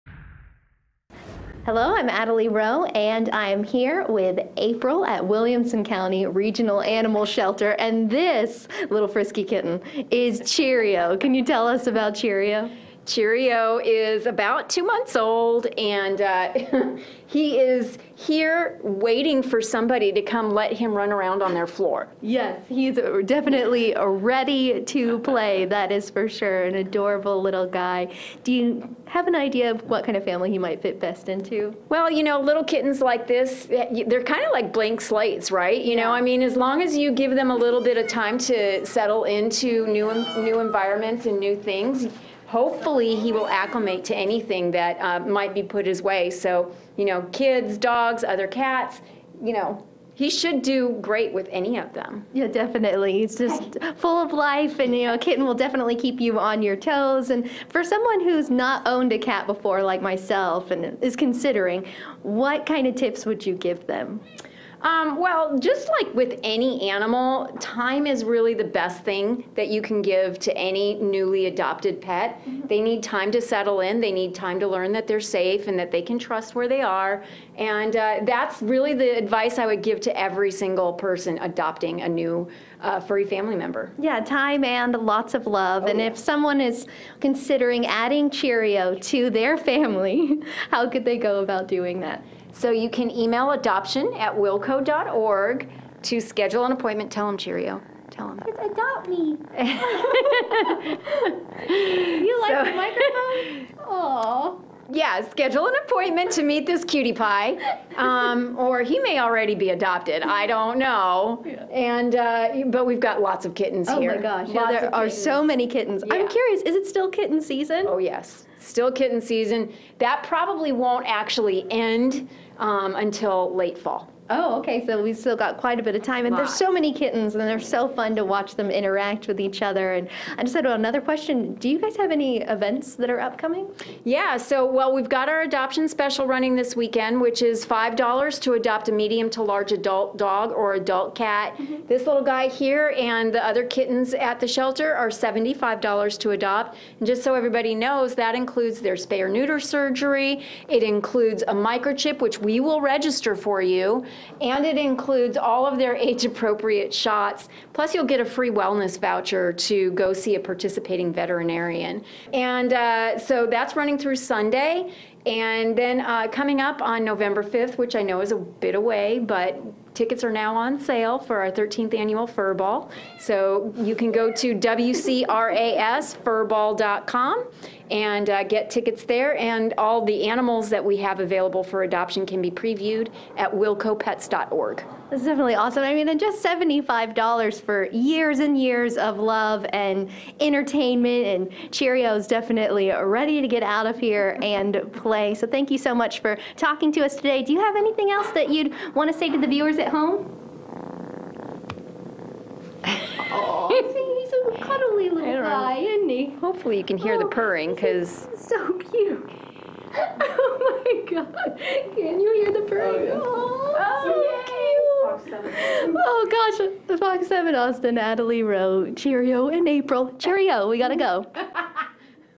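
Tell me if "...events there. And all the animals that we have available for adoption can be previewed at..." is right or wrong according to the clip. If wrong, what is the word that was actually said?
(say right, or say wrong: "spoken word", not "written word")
wrong: "tickets", not "events".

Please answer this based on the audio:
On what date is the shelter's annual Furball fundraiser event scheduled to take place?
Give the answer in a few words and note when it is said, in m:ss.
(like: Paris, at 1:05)
November 5th, at 2:47.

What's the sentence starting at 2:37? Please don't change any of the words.
Plus, you'll get a free wellness voucher to go see a participating veterinarian.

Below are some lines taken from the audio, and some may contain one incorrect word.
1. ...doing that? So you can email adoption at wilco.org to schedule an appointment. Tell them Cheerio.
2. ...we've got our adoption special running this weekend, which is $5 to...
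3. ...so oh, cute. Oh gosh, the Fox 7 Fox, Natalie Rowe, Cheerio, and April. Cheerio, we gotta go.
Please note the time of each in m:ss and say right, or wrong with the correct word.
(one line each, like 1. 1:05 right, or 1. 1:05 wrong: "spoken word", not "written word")
1. 1:31 right
2. 2:14 right
3. 3:35 wrong: "Austin", not "Fox".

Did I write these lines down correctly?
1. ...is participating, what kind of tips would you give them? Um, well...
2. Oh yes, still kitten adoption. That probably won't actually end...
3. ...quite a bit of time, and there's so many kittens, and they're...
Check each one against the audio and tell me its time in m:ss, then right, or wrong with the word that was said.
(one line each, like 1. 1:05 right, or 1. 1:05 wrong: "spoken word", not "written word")
1. 1:01 wrong: "considering", not "participating"
2. 1:57 wrong: "season", not "adoption"
3. 2:05 right.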